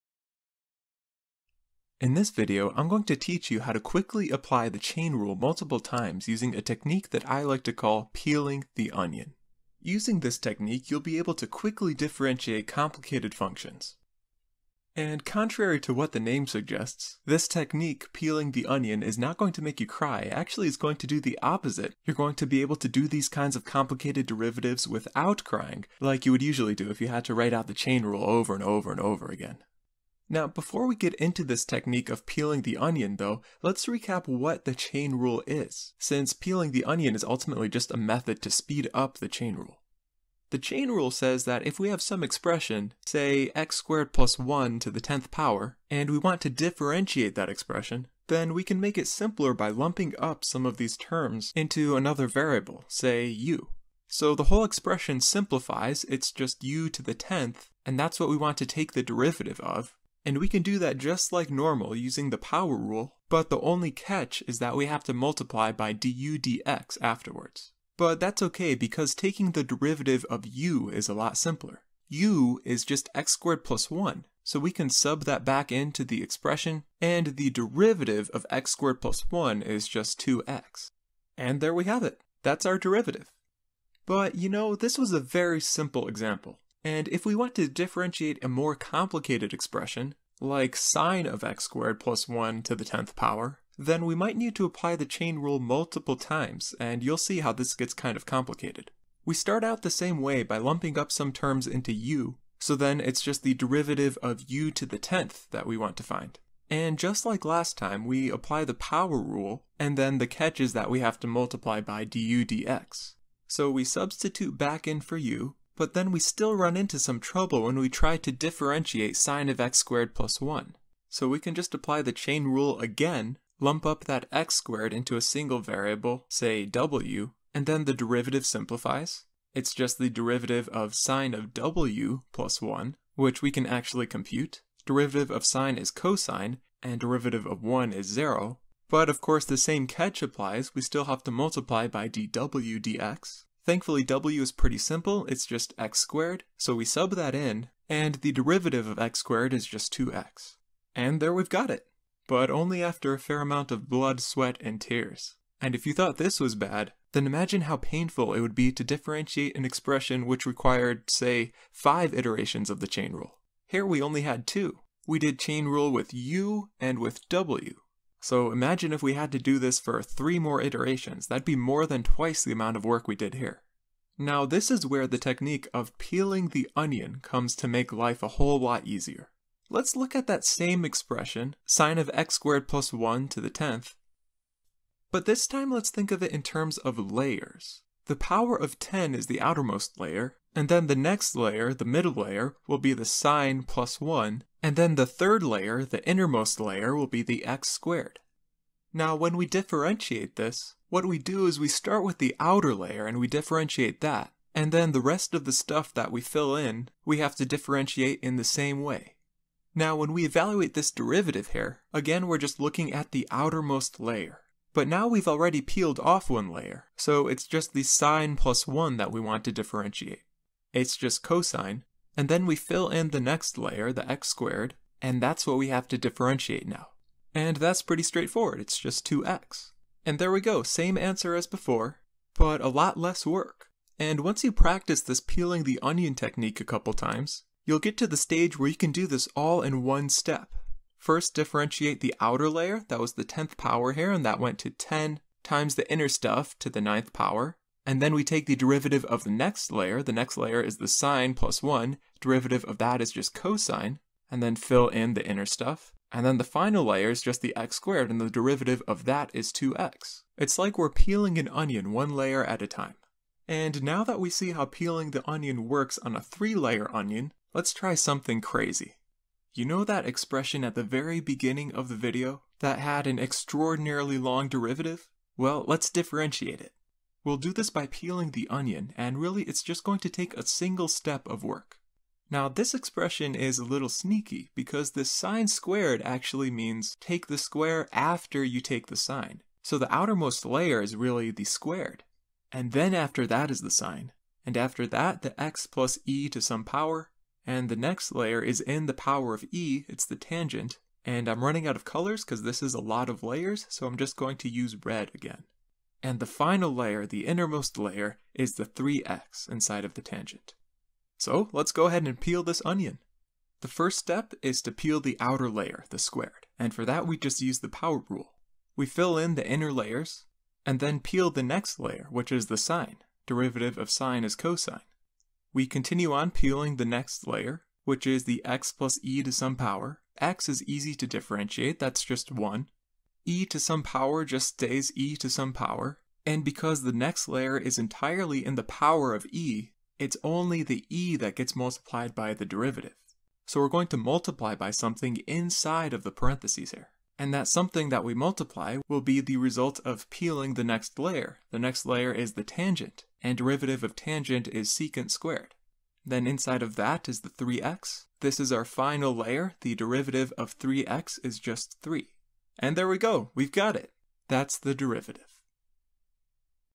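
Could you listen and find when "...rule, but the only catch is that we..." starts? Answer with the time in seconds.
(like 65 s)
62 s.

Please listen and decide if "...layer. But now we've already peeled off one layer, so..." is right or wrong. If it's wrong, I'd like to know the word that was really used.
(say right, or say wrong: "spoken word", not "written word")
right.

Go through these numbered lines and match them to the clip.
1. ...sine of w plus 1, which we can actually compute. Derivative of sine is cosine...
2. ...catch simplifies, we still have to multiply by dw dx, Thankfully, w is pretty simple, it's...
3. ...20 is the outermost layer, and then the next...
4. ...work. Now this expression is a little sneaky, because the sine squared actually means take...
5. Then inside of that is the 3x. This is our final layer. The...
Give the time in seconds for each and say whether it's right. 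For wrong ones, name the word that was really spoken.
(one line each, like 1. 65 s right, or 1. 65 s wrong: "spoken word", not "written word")
1. 130 s right
2. 139 s wrong: "applies", not "simplifies"
3. 188 s wrong: "10", not "20"
4. 281 s right
5. 356 s right.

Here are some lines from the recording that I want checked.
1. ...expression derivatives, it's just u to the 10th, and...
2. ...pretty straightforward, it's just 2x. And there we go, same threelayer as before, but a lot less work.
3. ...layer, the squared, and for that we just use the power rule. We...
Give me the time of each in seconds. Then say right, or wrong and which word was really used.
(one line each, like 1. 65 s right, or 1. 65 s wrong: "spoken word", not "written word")
1. 54 s wrong: "simplifies", not "derivatives"
2. 227 s wrong: "answer", not "threelayer"
3. 315 s right.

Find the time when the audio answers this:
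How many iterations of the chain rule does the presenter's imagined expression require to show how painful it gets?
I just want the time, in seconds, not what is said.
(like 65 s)
161 s.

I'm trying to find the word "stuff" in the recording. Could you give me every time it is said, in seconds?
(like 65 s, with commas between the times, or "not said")
205 s, 246 s, 255 s.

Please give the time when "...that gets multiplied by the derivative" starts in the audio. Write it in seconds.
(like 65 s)
341 s.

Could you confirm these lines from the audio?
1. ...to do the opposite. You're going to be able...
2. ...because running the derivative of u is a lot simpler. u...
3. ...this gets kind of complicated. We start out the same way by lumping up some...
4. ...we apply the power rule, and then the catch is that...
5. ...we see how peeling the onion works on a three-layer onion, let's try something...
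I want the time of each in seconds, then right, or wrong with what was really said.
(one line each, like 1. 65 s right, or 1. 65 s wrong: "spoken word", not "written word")
1. 20 s right
2. 68 s wrong: "taking", not "running"
3. 97 s right
4. 108 s right
5. 264 s right.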